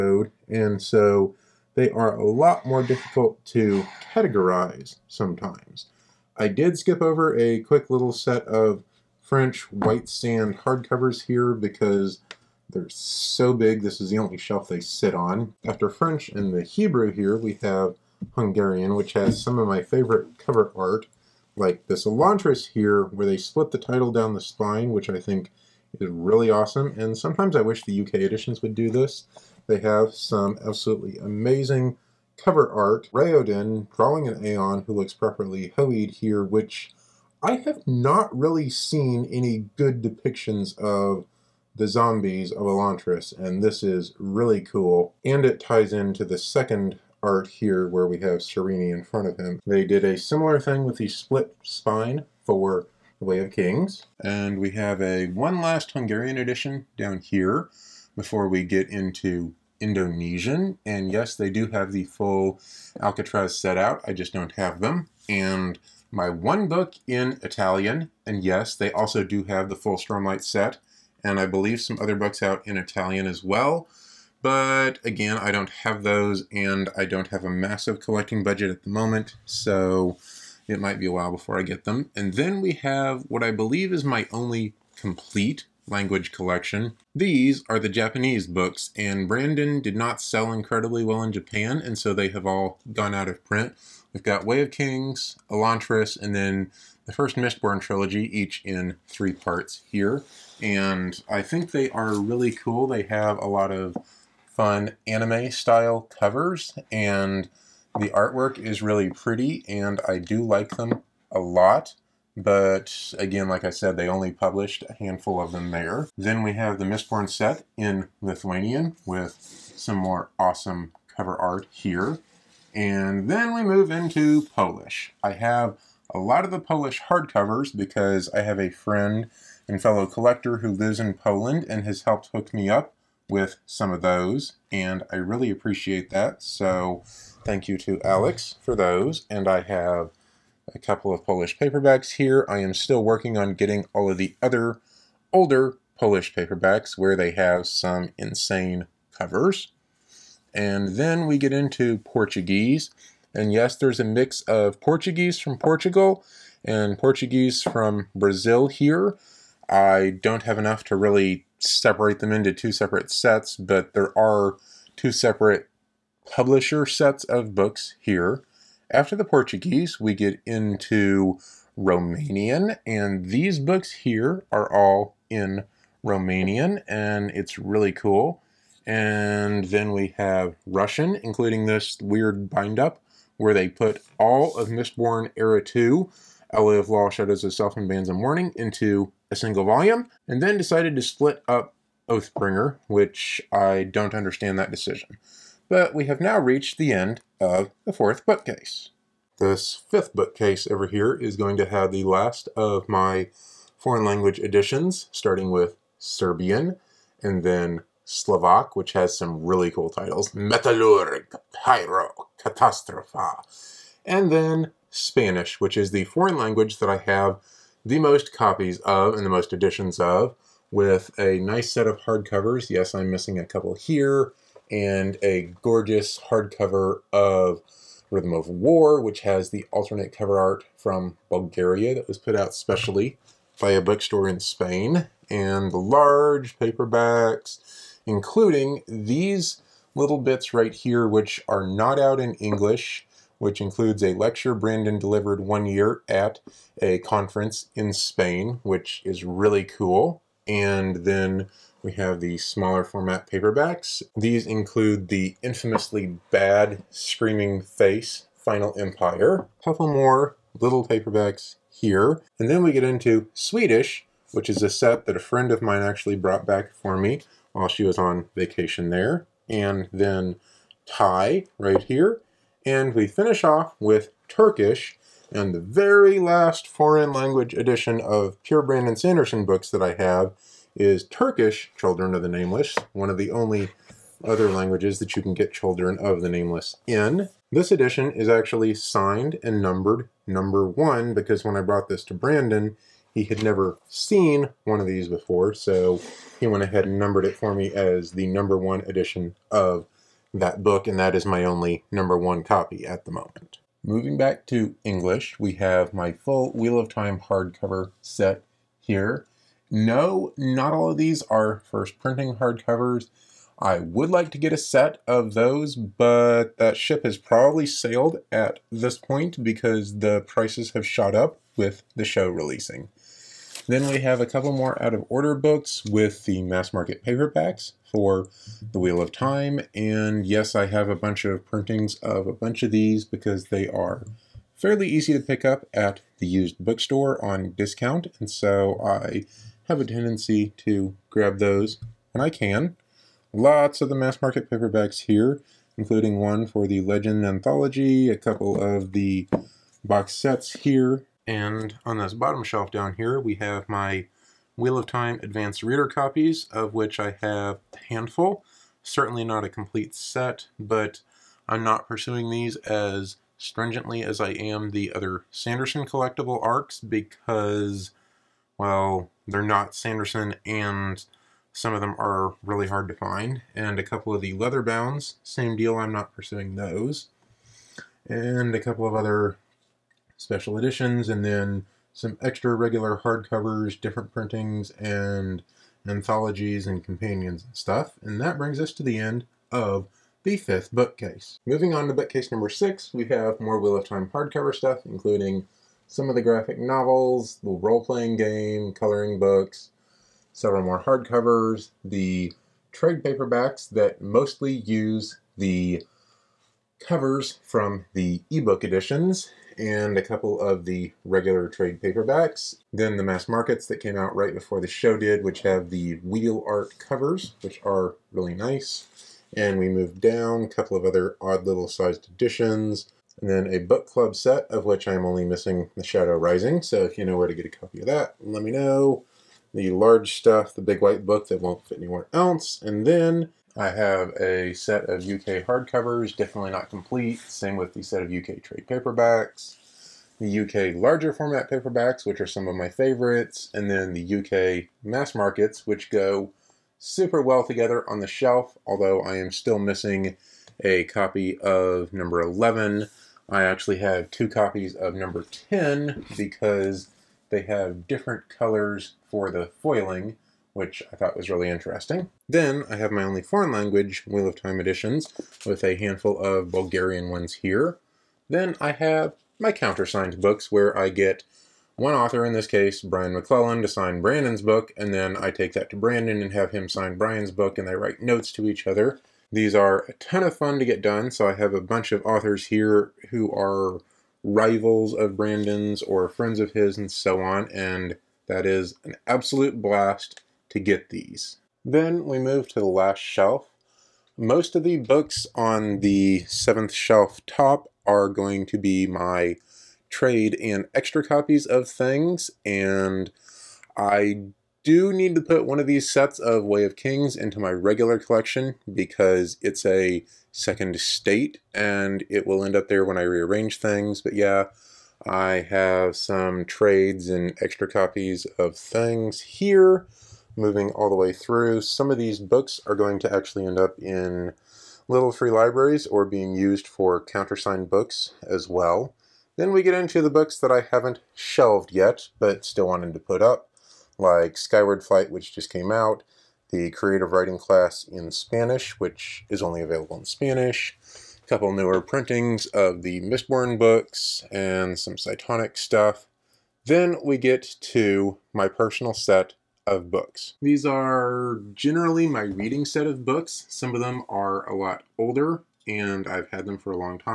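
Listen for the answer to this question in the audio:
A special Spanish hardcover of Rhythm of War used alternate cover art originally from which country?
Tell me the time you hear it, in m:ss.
3:51.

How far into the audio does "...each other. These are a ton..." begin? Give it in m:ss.
7:58.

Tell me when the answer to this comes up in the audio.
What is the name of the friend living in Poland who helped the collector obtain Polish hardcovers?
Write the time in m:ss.
2:18.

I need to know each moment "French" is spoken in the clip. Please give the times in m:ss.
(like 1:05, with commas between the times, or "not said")
0:09, 0:15.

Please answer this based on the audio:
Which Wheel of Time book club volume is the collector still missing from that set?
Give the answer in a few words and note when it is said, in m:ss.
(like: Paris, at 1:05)
The Shadow Rising, at 7:05.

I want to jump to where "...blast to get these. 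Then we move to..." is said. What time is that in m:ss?
8:09.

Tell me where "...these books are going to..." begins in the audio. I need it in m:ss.
8:41.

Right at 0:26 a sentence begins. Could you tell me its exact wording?
And sometimes I wish the UK editions would do this.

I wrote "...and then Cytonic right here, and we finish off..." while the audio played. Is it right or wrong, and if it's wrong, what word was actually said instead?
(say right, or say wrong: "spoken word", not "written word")
wrong: "Thai", not "Cytonic".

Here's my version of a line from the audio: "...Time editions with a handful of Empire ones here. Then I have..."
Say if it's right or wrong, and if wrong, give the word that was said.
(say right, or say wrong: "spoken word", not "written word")
wrong: "Bulgarian", not "Empire".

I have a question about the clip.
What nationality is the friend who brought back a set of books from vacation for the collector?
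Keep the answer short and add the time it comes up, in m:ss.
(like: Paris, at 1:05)
Swedish, at 4:23.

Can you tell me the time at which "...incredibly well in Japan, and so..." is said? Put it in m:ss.
1:30.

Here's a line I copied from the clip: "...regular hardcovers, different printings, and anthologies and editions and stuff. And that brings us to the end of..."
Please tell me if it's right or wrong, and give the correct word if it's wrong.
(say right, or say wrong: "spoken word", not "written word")
wrong: "companions", not "editions".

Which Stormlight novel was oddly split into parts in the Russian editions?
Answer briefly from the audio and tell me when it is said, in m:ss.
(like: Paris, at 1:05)
Oathbringer, at 3:12.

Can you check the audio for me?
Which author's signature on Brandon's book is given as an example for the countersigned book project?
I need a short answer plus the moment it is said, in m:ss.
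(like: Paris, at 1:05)
Brian McClellan, at 7:52.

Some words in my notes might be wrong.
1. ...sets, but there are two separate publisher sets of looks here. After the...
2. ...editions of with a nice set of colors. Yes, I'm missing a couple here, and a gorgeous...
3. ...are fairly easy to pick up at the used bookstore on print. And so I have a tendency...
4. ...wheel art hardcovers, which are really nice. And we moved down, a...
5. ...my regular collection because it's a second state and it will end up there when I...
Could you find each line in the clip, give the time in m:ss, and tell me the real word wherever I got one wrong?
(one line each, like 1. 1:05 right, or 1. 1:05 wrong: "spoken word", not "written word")
1. 2:43 wrong: "books", not "looks"
2. 3:39 wrong: "hardcovers", not "colors"
3. 5:33 wrong: "discount", not "print"
4. 6:55 wrong: "covers", not "hardcovers"
5. 8:27 right.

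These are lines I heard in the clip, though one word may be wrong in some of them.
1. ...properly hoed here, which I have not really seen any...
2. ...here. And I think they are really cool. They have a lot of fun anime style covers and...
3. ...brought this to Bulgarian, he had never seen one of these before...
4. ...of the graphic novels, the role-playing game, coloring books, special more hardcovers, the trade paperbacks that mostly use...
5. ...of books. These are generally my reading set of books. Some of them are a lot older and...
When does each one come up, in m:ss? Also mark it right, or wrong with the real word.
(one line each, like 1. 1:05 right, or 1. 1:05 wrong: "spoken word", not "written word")
1. 0:35 right
2. 1:39 right
3. 4:51 wrong: "Brandon", not "Bulgarian"
4. 6:36 wrong: "several", not "special"
5. 9:09 right.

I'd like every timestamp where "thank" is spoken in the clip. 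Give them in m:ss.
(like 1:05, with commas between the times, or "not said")
2:17.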